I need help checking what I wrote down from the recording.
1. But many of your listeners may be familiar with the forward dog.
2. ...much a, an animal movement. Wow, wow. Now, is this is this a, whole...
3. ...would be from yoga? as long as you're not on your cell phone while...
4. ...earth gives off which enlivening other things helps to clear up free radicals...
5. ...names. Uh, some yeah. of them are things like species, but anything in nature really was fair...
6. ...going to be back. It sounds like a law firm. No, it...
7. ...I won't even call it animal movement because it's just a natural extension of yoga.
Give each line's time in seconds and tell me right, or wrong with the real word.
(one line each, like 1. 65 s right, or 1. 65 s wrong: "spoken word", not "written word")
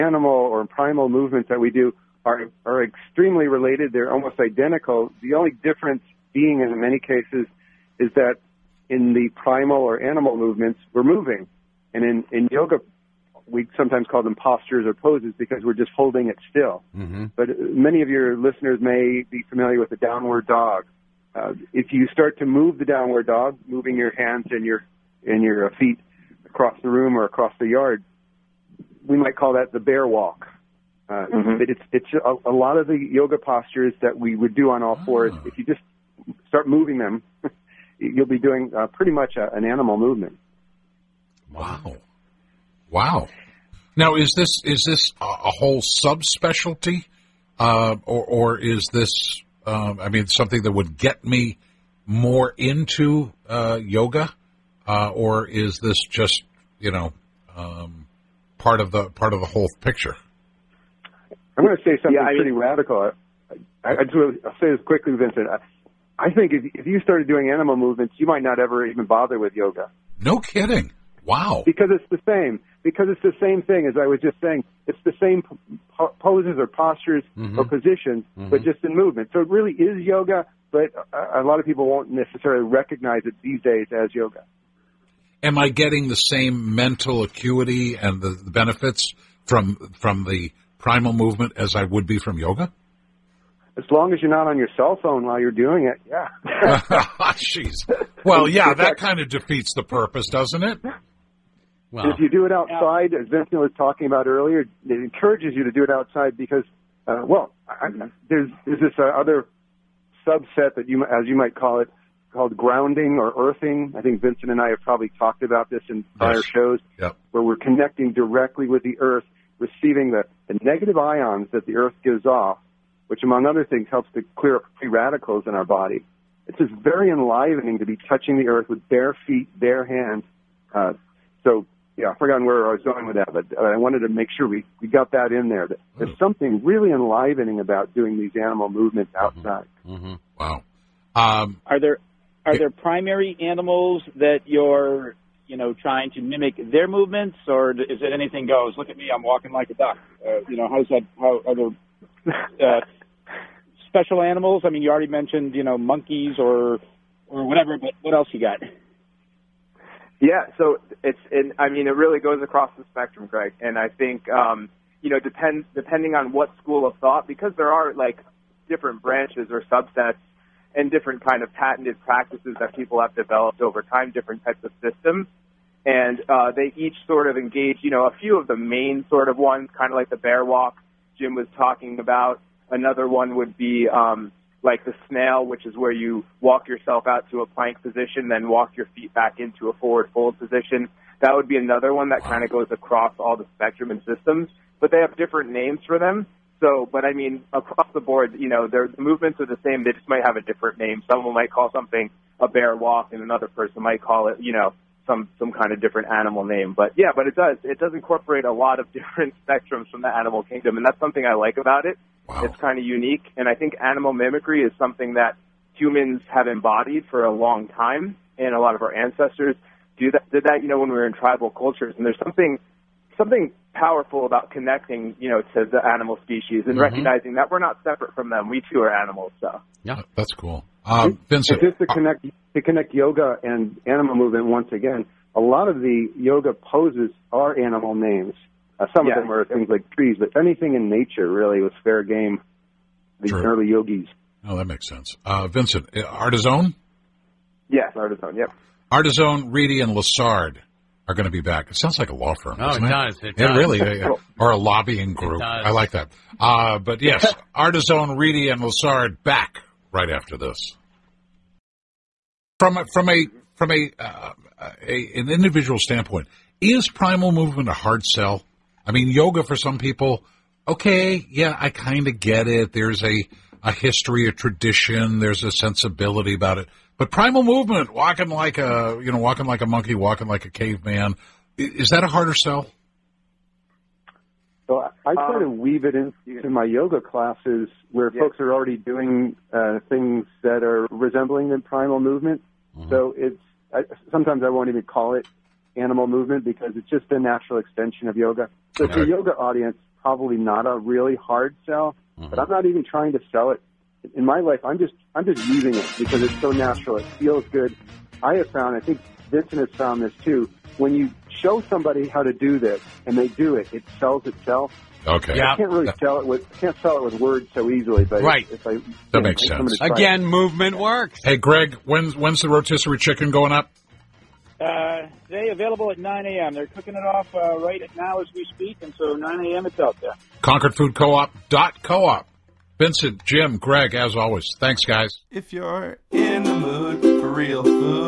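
1. 17 s wrong: "downward", not "forward"
2. 39 s right
3. 91 s right
4. 121 s wrong: "among", not "enlivening"
5. 237 s wrong: "trees", not "species"
6. 251 s right
7. 294 s right.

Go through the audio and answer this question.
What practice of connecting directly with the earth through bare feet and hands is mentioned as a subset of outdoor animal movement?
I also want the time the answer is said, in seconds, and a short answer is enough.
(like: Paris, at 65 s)
grounding or earthing, at 112 s.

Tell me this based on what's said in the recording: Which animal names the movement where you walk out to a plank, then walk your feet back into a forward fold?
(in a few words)
snail.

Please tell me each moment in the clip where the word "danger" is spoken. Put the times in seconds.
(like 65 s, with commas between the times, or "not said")
not said.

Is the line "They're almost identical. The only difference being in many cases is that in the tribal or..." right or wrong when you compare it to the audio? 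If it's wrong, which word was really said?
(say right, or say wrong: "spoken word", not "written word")
wrong: "primal", not "tribal".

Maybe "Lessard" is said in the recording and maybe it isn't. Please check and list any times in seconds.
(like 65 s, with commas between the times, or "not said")
249 s, 258 s.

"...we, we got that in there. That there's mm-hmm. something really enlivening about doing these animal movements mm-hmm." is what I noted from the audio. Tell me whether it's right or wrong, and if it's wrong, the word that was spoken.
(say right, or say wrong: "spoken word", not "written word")
right.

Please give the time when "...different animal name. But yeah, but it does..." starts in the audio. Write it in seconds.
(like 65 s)
205 s.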